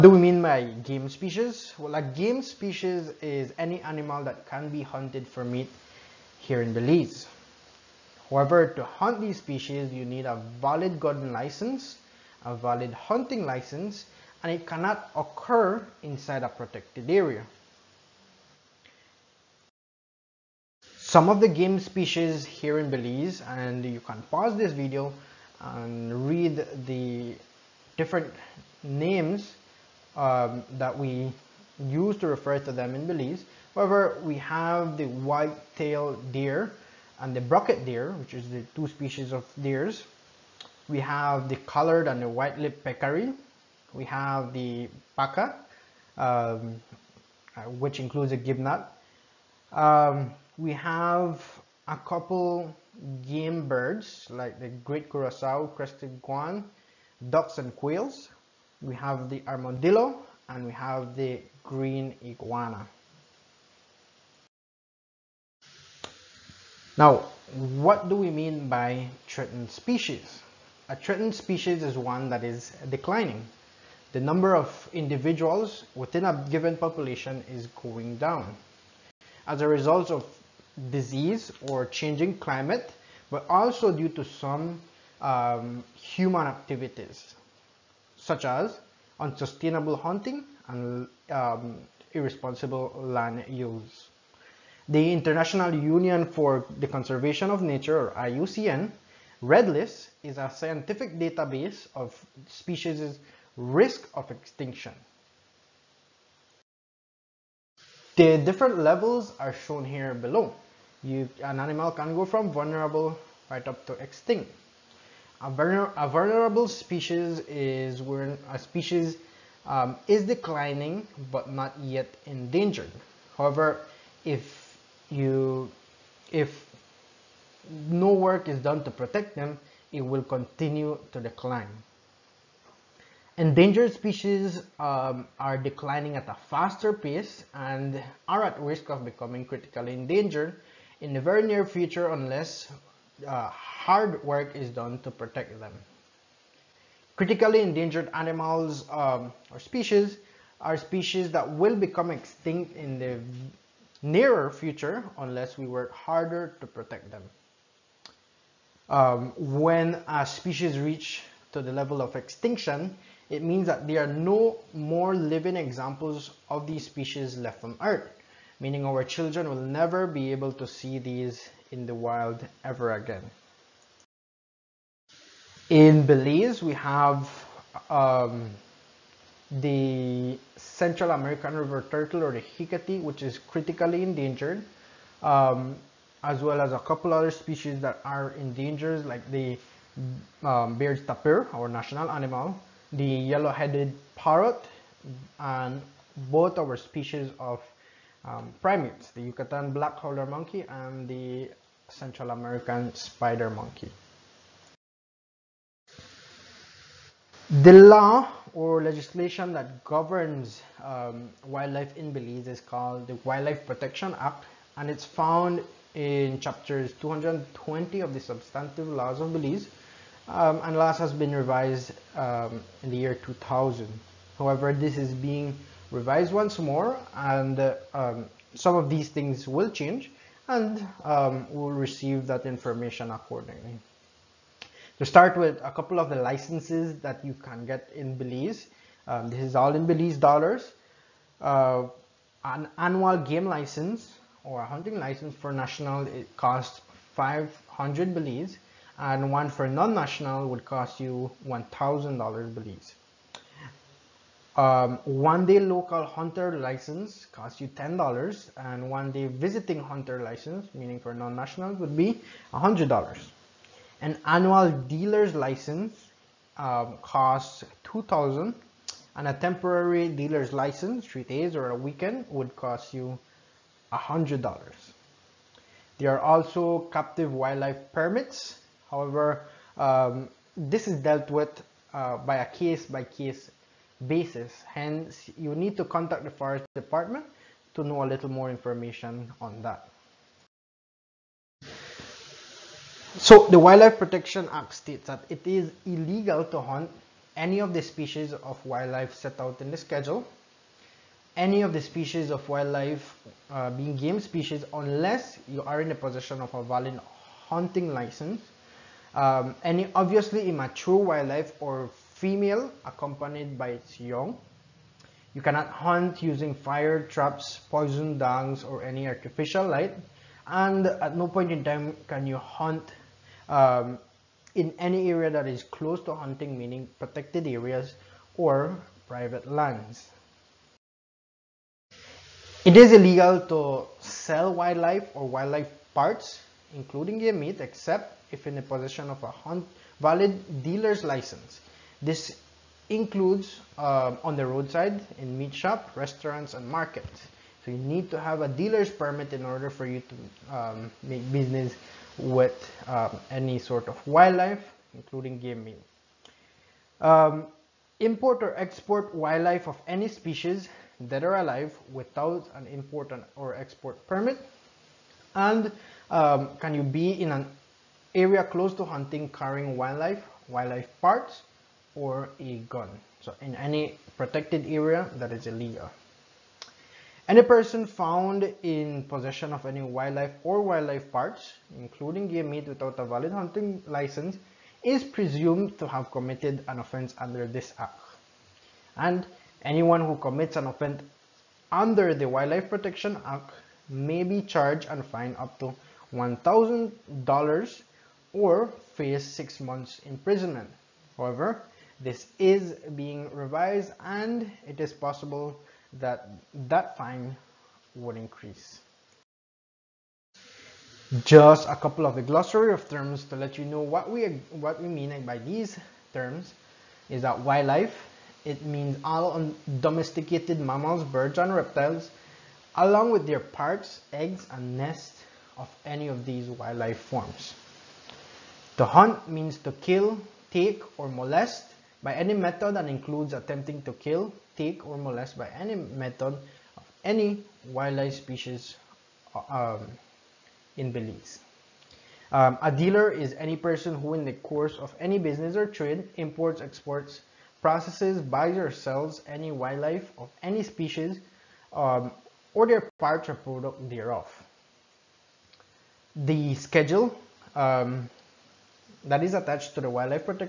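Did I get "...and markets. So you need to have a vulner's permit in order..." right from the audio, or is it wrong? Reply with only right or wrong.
wrong.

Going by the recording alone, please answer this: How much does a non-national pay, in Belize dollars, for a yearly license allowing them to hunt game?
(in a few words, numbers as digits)
$1,000.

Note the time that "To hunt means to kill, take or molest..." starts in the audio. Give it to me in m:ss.
7:08.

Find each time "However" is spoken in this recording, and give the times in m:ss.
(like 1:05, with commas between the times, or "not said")
0:08, 0:33, 2:03, 3:44, 4:38, 6:41.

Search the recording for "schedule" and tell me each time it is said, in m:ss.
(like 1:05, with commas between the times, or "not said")
4:59, 7:36.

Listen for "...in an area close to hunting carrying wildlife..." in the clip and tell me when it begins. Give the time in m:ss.
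6:07.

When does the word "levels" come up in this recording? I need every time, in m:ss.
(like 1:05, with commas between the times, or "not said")
1:48, 2:41.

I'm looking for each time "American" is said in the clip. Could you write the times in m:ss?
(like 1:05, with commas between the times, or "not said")
3:01, 3:22.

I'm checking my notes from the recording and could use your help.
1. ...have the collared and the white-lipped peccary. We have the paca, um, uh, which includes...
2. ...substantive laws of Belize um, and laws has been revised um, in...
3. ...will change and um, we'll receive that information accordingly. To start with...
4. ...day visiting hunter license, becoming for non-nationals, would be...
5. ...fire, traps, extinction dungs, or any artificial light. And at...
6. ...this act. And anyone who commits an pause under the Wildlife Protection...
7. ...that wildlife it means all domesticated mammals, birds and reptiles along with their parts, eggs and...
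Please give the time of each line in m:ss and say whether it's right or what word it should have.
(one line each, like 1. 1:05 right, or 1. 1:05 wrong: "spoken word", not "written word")
1. 0:41 right
2. 3:38 right
3. 3:49 right
4. 4:19 wrong: "meaning", not "becoming"
5. 5:16 wrong: "poison", not "extinction"
6. 6:27 wrong: "offense", not "pause"
7. 6:57 right.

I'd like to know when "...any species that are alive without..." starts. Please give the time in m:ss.
5:59.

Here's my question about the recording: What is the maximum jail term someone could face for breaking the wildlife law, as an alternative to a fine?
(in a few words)
six months.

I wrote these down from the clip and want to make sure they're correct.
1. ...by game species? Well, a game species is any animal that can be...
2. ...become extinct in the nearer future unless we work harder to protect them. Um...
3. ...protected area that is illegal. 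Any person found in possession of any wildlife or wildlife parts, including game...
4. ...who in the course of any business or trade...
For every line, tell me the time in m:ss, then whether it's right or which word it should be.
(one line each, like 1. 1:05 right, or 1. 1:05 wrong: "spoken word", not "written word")
1. 0:00 right
2. 2:31 right
3. 6:14 right
4. 7:24 right.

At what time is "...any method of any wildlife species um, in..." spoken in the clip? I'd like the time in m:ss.
7:15.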